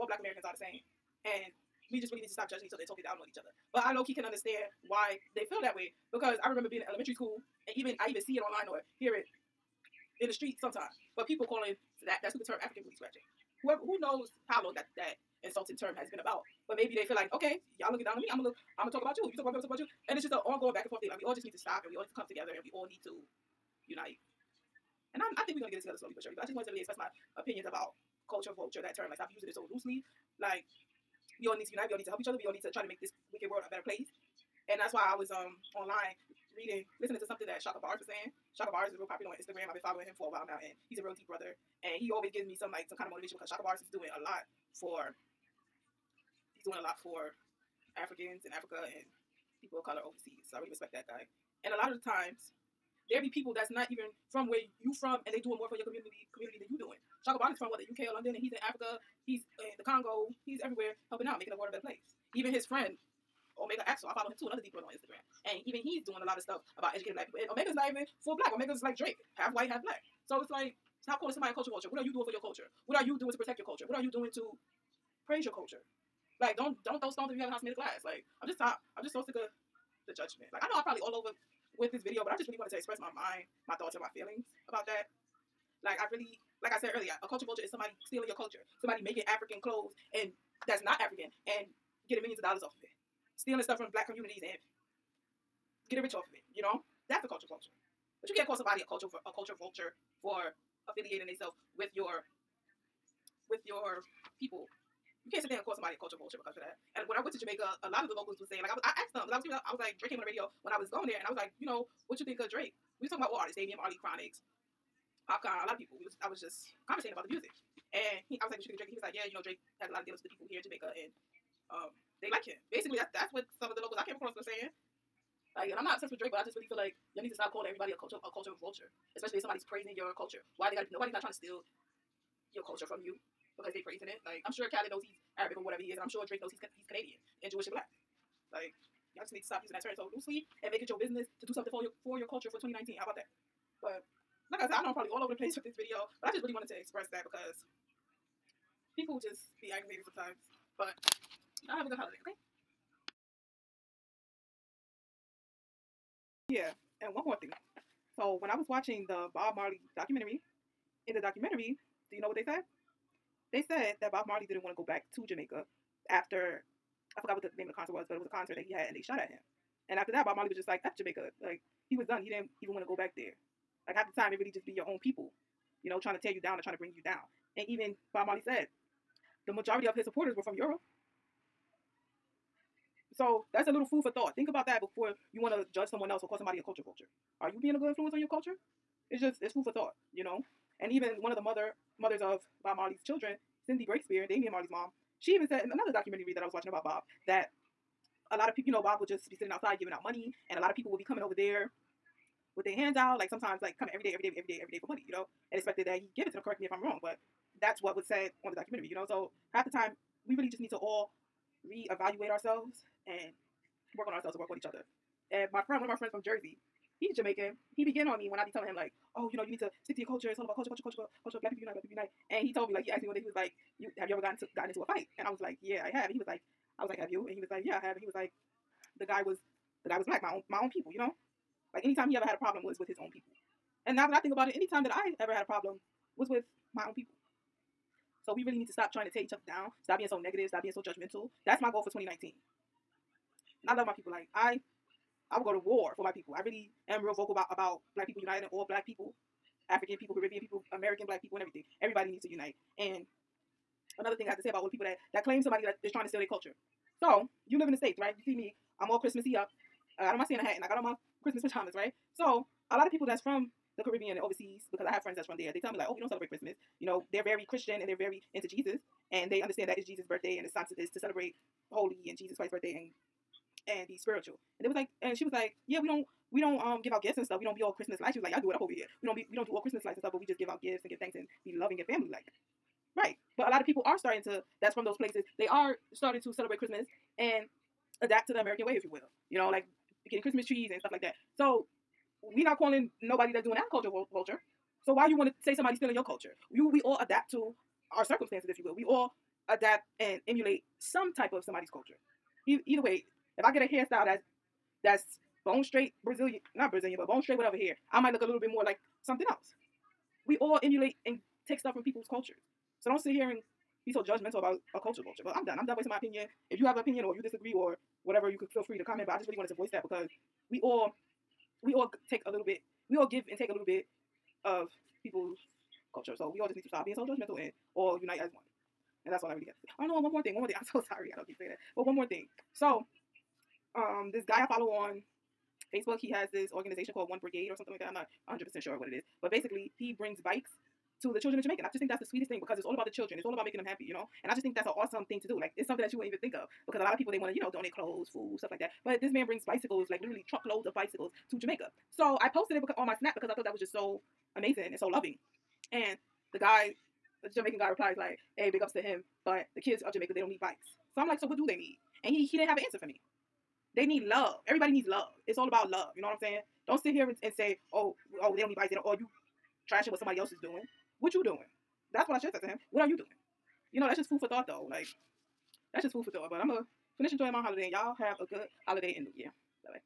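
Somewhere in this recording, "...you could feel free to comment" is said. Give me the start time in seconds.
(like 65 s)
318 s.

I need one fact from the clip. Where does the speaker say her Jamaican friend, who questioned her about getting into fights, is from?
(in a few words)
Jersey.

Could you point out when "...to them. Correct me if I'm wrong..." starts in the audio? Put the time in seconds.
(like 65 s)
206 s.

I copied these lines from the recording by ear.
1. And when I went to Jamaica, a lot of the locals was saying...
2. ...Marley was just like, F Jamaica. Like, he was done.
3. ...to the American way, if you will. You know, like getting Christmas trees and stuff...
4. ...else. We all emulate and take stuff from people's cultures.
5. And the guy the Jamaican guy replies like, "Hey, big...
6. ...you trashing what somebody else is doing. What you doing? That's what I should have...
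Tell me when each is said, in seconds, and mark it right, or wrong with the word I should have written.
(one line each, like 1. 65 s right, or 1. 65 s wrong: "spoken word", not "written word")
1. 106 s right
2. 170 s right
3. 288 s right
4. 309 s right
5. 355 s right
6. 368 s right.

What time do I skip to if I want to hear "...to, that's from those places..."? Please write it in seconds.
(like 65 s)
284 s.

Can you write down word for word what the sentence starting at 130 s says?
Nobody's not trying to steal your culture from you because they praising it.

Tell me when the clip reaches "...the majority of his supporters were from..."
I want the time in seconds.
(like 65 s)
179 s.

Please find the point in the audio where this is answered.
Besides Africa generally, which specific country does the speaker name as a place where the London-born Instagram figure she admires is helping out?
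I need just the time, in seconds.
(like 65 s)
59 s.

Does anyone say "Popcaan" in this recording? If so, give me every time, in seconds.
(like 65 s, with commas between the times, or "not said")
115 s.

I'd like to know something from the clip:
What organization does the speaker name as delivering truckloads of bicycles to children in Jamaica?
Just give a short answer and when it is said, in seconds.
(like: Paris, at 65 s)
One Brigade, at 337 s.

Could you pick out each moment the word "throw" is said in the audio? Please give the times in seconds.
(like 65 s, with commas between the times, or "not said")
77 s.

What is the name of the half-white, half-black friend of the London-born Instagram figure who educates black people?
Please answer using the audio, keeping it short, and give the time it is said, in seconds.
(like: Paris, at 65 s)
Omega Axel, at 63 s.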